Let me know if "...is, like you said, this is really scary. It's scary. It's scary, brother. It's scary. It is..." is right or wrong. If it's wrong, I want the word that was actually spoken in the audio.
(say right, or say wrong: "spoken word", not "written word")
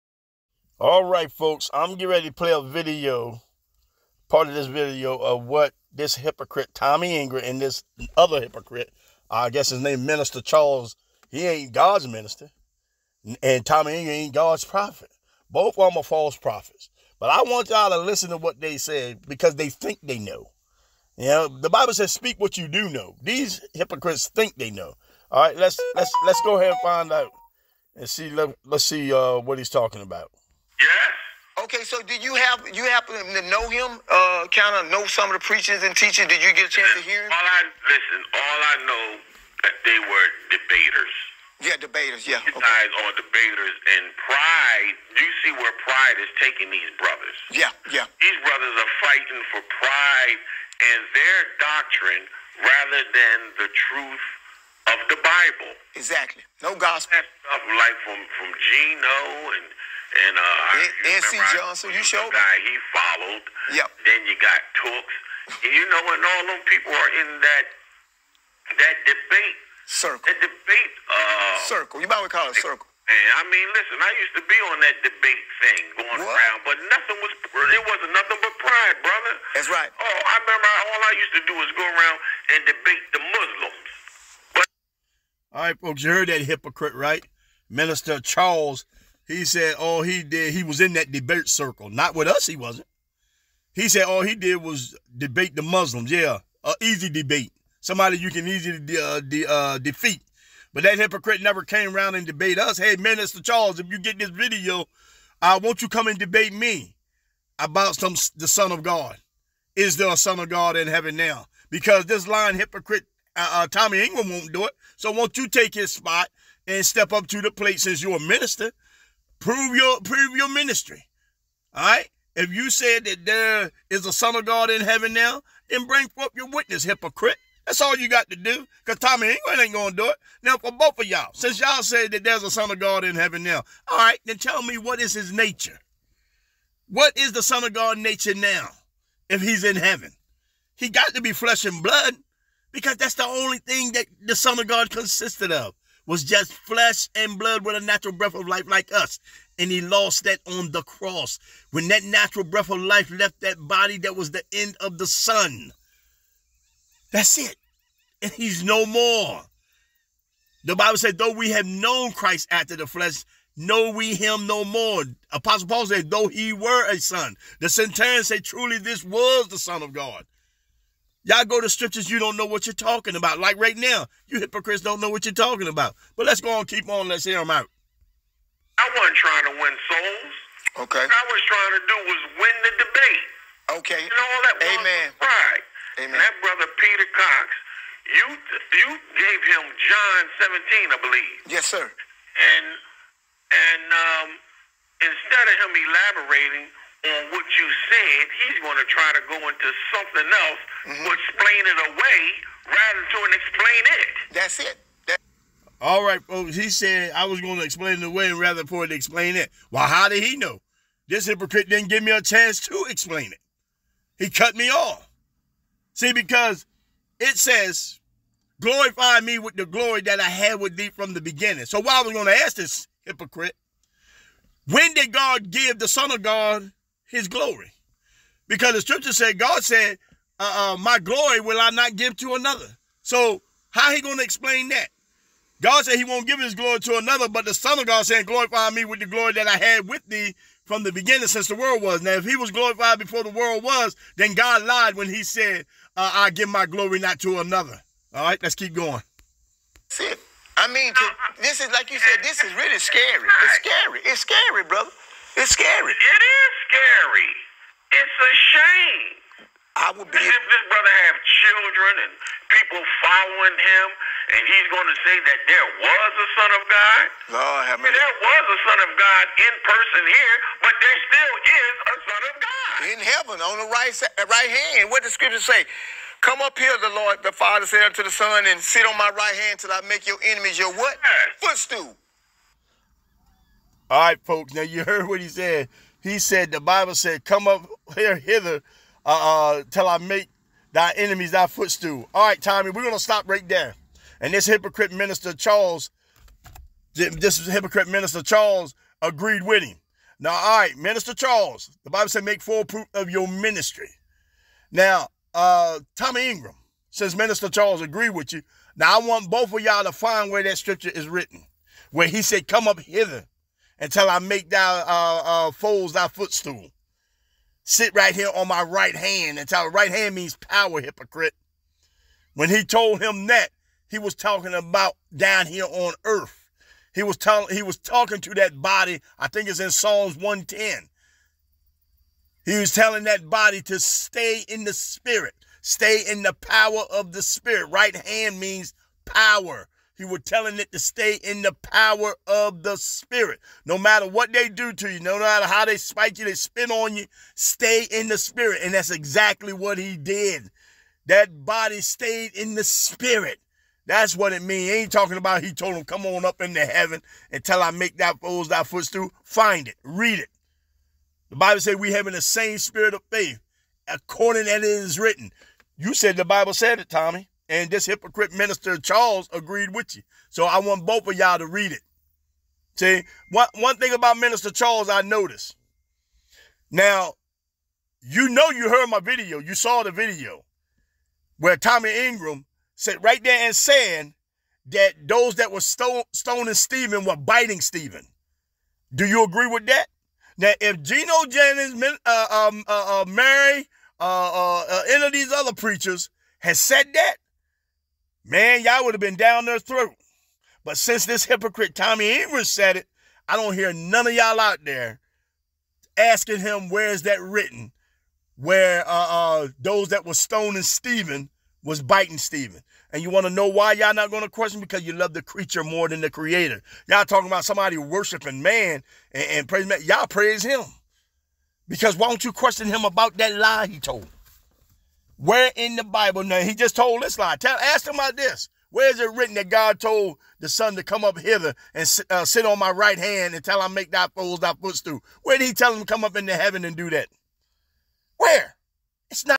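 right.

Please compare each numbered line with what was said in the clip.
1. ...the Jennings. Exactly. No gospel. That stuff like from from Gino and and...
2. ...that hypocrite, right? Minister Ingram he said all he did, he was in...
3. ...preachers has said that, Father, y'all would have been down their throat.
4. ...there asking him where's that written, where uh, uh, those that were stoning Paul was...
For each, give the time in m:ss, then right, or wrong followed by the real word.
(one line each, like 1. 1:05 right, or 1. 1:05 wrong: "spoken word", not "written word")
1. 0:55 wrong: "Bible", not "Jennings"
2. 1:26 wrong: "Charles", not "Ingram"
3. 6:35 wrong: "Man", not "Father"
4. 6:44 wrong: "Stephen", not "Paul".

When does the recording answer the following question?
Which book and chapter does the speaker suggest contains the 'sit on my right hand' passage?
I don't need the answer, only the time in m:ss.
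5:29.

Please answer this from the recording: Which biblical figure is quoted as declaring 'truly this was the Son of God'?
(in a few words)
The centurion.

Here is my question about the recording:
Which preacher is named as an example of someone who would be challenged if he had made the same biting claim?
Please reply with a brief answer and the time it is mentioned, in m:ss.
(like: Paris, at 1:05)
Gino Jennings, at 6:30.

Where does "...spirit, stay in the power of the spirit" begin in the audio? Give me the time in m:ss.
5:34.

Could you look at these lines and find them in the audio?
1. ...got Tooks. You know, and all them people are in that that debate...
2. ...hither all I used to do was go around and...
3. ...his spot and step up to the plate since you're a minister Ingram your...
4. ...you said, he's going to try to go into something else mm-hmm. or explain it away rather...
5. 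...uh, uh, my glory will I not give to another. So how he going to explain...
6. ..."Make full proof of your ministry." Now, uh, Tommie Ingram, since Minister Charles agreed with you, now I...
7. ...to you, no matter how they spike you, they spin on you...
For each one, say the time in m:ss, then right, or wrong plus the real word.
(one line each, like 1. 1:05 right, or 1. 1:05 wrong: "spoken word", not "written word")
1. 1:04 right
2. 1:20 wrong: "remember", not "hither"
3. 1:55 wrong: "Prove", not "Ingram"
4. 3:17 right
5. 3:50 right
6. 5:02 right
7. 5:44 right.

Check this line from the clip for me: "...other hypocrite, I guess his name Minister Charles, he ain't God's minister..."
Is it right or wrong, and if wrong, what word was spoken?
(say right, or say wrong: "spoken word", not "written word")
right.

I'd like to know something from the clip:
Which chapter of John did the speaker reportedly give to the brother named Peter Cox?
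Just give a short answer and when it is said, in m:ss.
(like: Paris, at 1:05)
John 17, at 3:09.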